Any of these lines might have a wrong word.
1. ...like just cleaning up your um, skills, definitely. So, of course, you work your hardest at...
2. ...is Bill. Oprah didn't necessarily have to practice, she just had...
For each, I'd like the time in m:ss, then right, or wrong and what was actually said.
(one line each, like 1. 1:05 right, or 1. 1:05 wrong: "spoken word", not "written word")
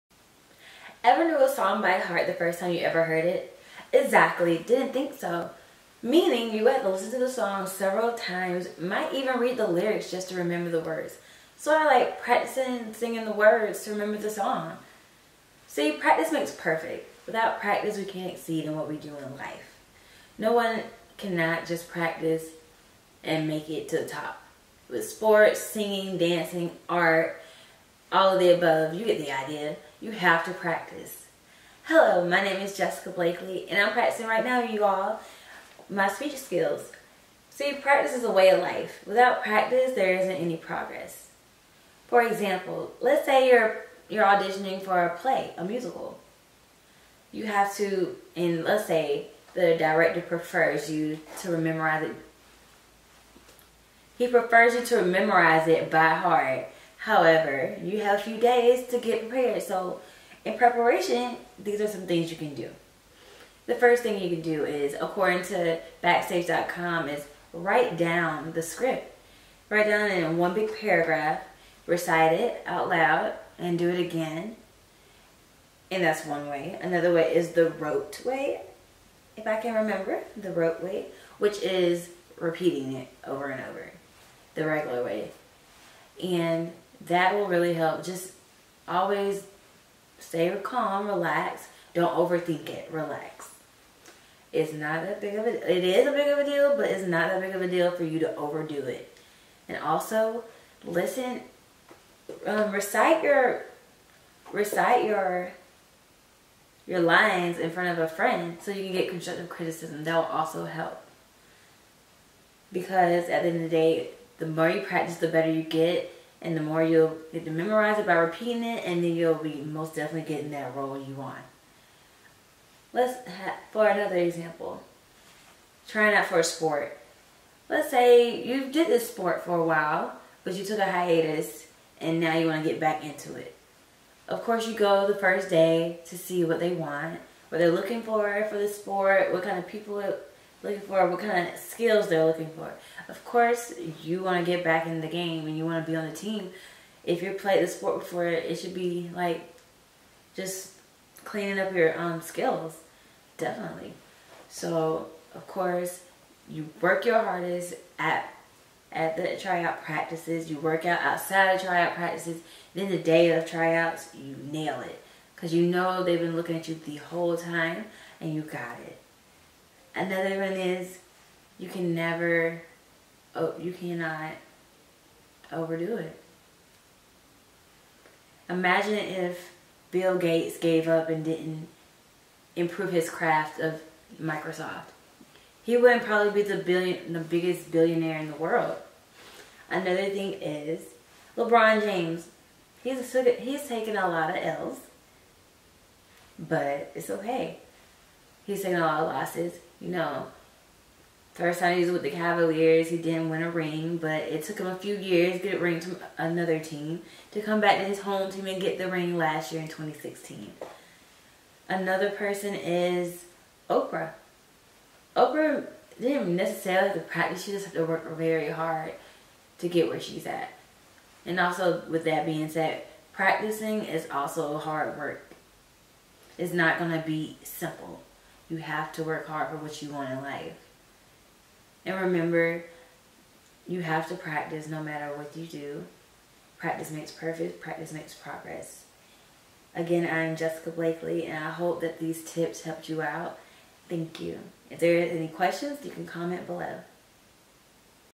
1. 2:29 right
2. 3:32 wrong: "Oprah", not "Bill".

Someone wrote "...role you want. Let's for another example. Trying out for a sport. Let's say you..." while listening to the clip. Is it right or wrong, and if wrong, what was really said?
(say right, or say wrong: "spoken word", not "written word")
right.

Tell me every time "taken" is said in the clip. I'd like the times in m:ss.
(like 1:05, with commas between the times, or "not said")
3:13, 3:18.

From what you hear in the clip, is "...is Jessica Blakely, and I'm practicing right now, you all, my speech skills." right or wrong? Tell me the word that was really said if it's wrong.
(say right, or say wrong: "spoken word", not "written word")
right.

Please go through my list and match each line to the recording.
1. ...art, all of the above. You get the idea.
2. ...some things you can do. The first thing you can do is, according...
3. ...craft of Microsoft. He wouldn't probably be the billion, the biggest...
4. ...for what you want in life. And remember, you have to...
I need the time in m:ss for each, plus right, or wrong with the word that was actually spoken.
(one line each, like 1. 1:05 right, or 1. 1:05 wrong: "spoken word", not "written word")
1. 0:26 right
2. 1:01 right
3. 3:03 right
4. 3:49 right.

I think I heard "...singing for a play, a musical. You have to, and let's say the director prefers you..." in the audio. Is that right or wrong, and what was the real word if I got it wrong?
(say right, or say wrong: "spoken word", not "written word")
wrong: "auditioning", not "singing".